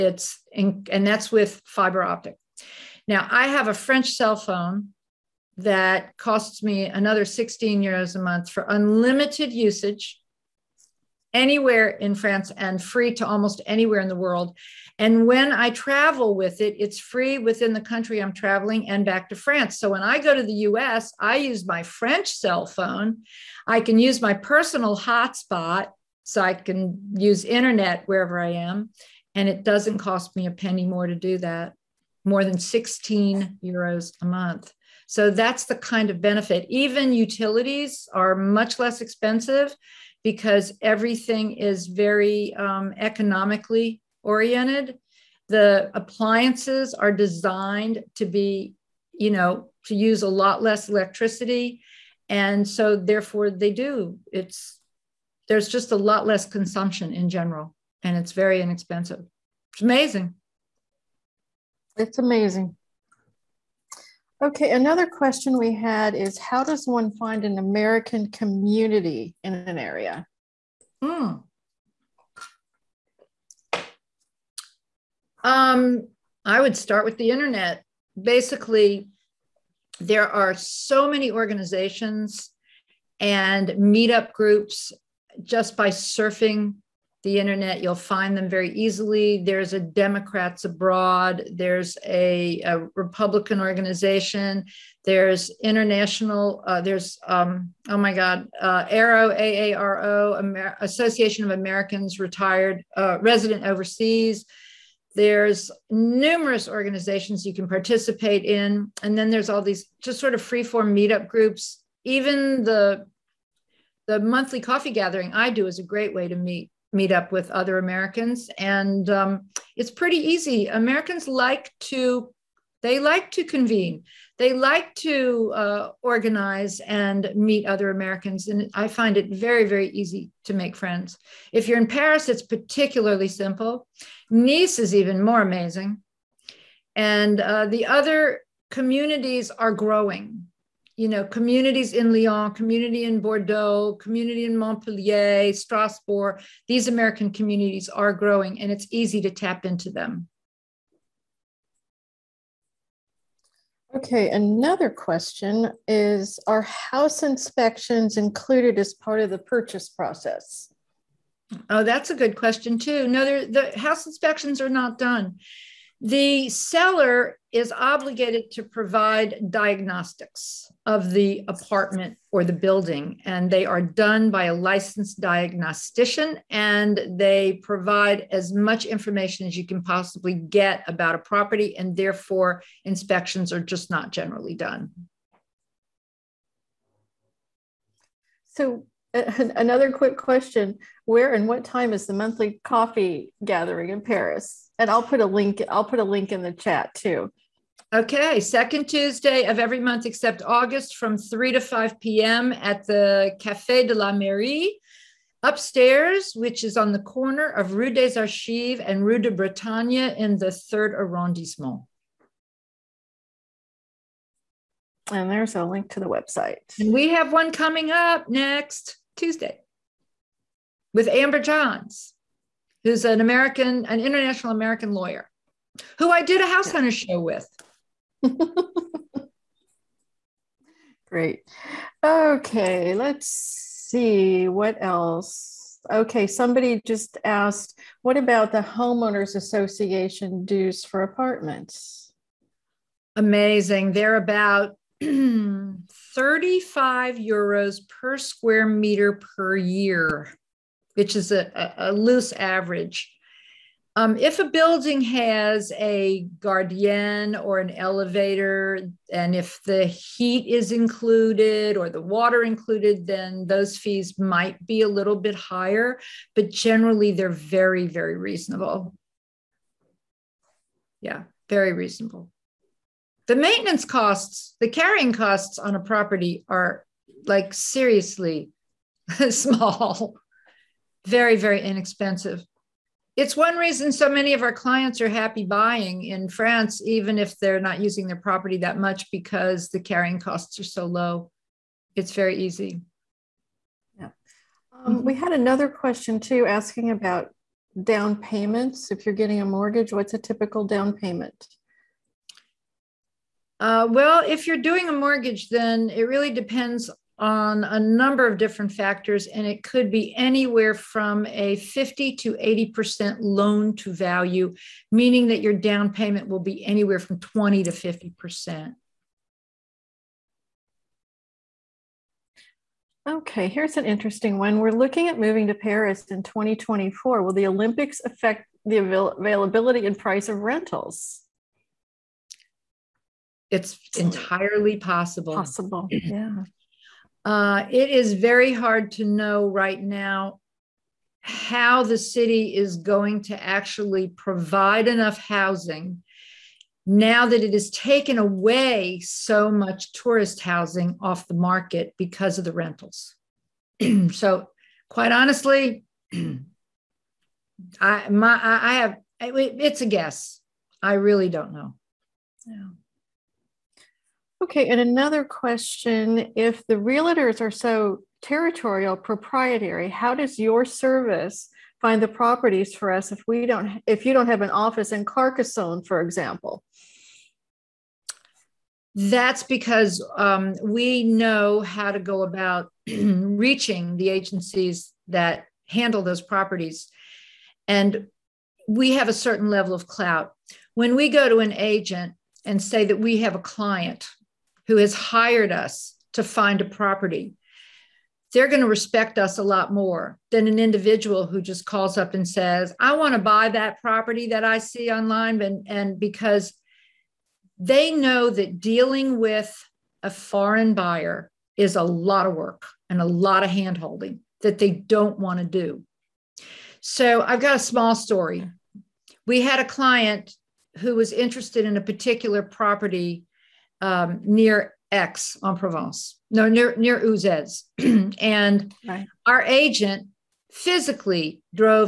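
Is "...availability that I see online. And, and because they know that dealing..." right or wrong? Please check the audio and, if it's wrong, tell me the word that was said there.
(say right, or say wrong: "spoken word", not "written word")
wrong: "property", not "availability".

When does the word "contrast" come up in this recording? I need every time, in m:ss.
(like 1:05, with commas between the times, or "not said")
not said.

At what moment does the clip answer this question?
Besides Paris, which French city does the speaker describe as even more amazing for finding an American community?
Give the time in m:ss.
2:14.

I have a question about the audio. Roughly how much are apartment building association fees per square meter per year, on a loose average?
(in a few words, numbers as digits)
35 euros.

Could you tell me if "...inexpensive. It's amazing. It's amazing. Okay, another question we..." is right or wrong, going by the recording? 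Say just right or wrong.
right.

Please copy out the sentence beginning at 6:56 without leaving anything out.
So I've got a small story.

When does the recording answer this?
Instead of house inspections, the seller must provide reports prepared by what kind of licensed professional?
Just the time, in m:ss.
2:55.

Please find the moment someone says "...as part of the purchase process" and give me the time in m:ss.
2:38.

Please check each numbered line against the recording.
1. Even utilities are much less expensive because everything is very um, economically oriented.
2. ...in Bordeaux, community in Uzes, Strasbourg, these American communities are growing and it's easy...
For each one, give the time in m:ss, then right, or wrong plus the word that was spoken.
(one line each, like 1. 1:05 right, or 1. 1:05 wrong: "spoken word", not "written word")
1. 0:36 right
2. 2:23 wrong: "Montpellier", not "Uzes".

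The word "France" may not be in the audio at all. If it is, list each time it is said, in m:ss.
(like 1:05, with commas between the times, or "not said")
0:12, 0:19, 4:46.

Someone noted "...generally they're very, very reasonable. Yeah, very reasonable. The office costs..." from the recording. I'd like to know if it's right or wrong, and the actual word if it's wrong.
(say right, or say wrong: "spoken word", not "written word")
wrong: "maintenance", not "office".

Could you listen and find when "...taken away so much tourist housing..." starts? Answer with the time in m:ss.
5:47.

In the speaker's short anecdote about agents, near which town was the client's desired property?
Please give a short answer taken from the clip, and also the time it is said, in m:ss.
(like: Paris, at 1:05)
Uzes, at 7:06.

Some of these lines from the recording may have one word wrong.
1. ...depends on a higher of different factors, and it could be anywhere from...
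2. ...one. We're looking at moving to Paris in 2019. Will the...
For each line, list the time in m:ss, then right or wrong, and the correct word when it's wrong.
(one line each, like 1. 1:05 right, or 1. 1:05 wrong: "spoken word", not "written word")
1. 5:06 wrong: "number", not "higher"
2. 5:24 wrong: "2024", not "2019".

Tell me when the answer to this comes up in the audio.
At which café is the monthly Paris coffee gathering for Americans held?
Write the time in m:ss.
3:23.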